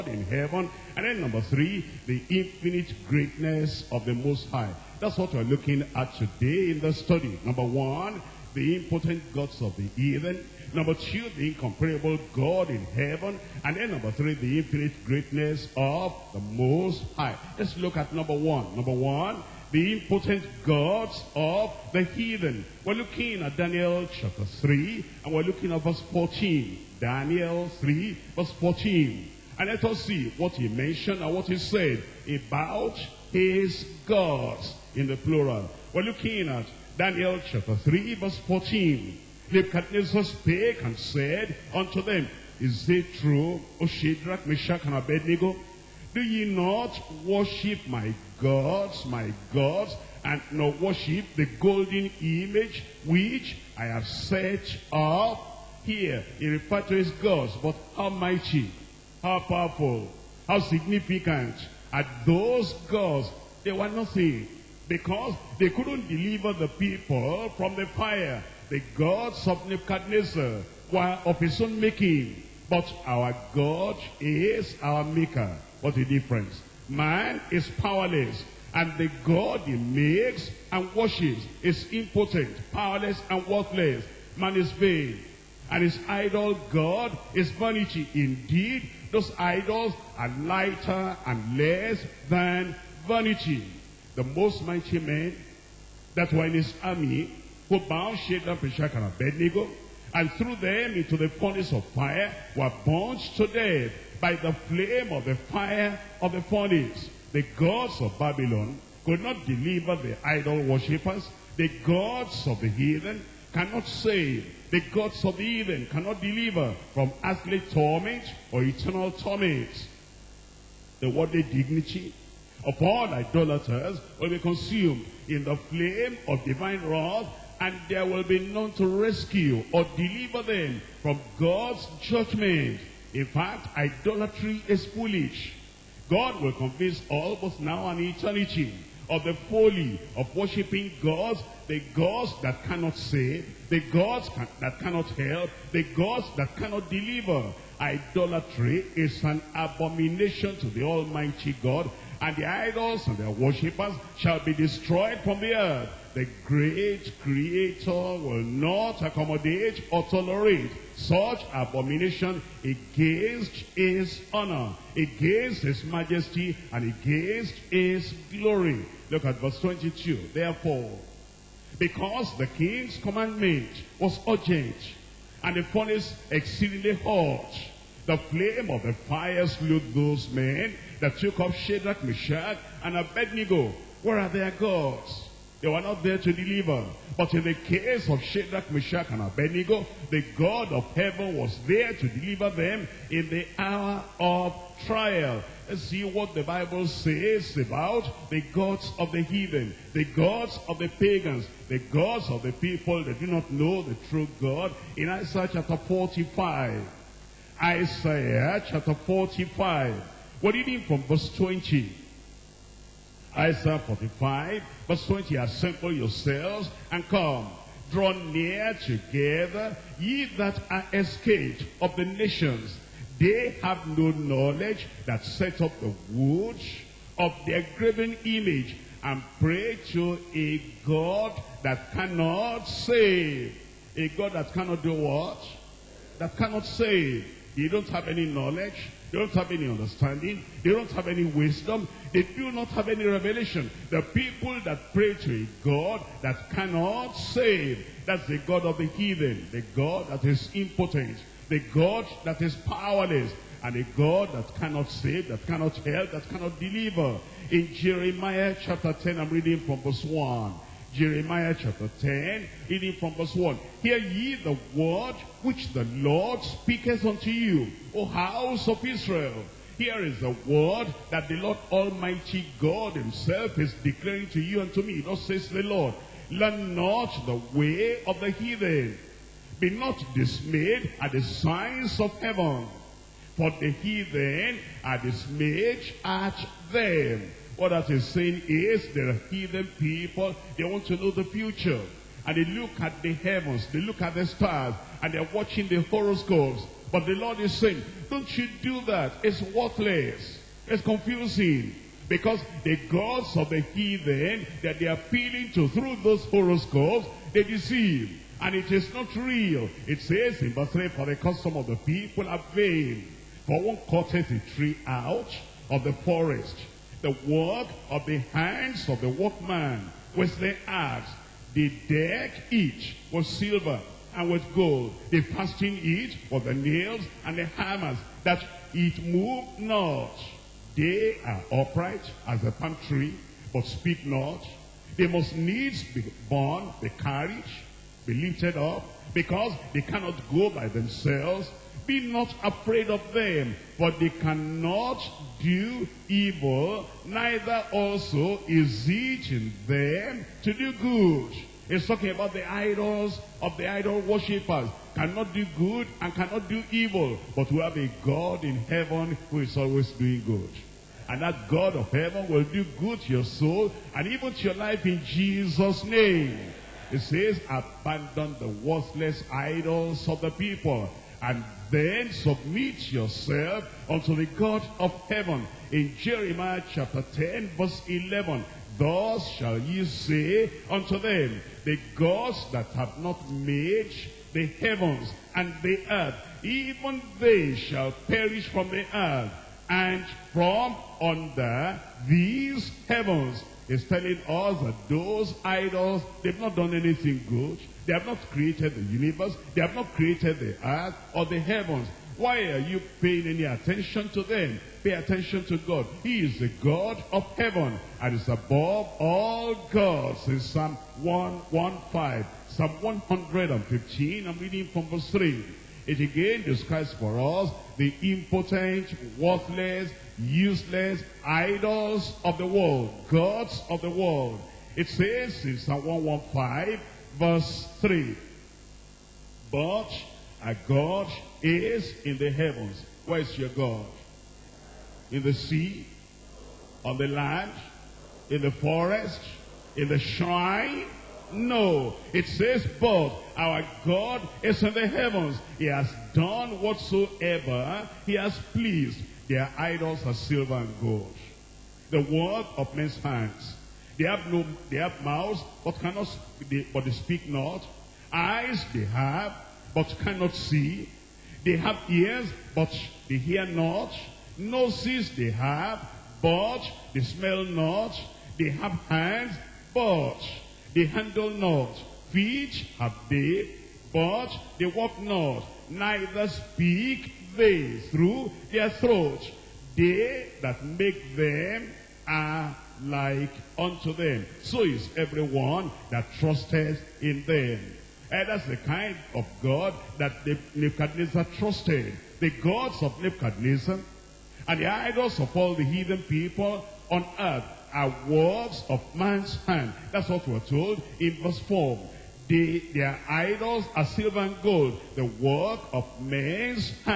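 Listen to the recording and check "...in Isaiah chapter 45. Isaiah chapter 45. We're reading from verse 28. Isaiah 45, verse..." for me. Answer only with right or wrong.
wrong.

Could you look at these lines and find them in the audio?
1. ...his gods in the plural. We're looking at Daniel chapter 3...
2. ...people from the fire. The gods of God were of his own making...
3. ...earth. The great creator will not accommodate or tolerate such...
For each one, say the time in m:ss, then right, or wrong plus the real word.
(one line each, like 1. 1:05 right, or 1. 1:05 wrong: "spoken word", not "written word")
1. 0:33 right
2. 1:06 wrong: "Nebuchadnezzar", not "God"
3. 2:35 right.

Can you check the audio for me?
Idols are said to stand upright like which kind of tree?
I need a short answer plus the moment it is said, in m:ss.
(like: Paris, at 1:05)
A palm tree, at 5:32.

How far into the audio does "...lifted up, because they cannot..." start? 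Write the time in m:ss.
5:38.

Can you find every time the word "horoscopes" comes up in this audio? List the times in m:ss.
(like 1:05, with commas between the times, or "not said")
4:55, 5:06.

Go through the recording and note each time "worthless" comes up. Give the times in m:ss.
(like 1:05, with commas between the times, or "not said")
1:23, 4:59, 6:08, 6:59.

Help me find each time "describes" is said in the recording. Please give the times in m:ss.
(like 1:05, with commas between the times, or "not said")
6:56.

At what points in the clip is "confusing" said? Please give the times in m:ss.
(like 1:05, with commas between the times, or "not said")
5:00.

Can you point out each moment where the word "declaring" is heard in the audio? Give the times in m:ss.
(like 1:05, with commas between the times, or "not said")
4:33.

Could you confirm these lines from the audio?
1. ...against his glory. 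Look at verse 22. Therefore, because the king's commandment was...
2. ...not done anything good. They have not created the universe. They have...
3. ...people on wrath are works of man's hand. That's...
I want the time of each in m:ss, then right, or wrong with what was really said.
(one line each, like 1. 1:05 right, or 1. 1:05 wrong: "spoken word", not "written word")
1. 2:46 right
2. 6:36 right
3. 8:16 wrong: "earth", not "wrath".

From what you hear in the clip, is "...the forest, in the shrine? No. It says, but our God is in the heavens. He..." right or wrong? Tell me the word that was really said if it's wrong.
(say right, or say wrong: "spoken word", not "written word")
right.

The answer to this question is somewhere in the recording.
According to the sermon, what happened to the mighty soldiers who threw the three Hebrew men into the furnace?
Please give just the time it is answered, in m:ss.
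1:42.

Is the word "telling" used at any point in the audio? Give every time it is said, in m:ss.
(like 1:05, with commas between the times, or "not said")
6:33.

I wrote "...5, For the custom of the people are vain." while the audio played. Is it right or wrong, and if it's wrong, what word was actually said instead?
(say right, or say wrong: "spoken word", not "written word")
wrong: "3", not "5".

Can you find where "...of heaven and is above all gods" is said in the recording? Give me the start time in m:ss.
6:47.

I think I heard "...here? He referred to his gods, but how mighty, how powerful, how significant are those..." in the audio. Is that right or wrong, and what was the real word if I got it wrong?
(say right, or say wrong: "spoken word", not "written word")
right.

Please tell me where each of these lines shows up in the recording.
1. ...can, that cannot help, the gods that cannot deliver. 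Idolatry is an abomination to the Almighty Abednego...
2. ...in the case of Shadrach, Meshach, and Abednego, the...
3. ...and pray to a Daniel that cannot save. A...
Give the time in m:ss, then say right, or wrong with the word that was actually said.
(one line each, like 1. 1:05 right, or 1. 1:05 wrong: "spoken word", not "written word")
1. 2:24 wrong: "God", not "Abednego"
2. 3:07 right
3. 3:49 wrong: "God", not "Daniel".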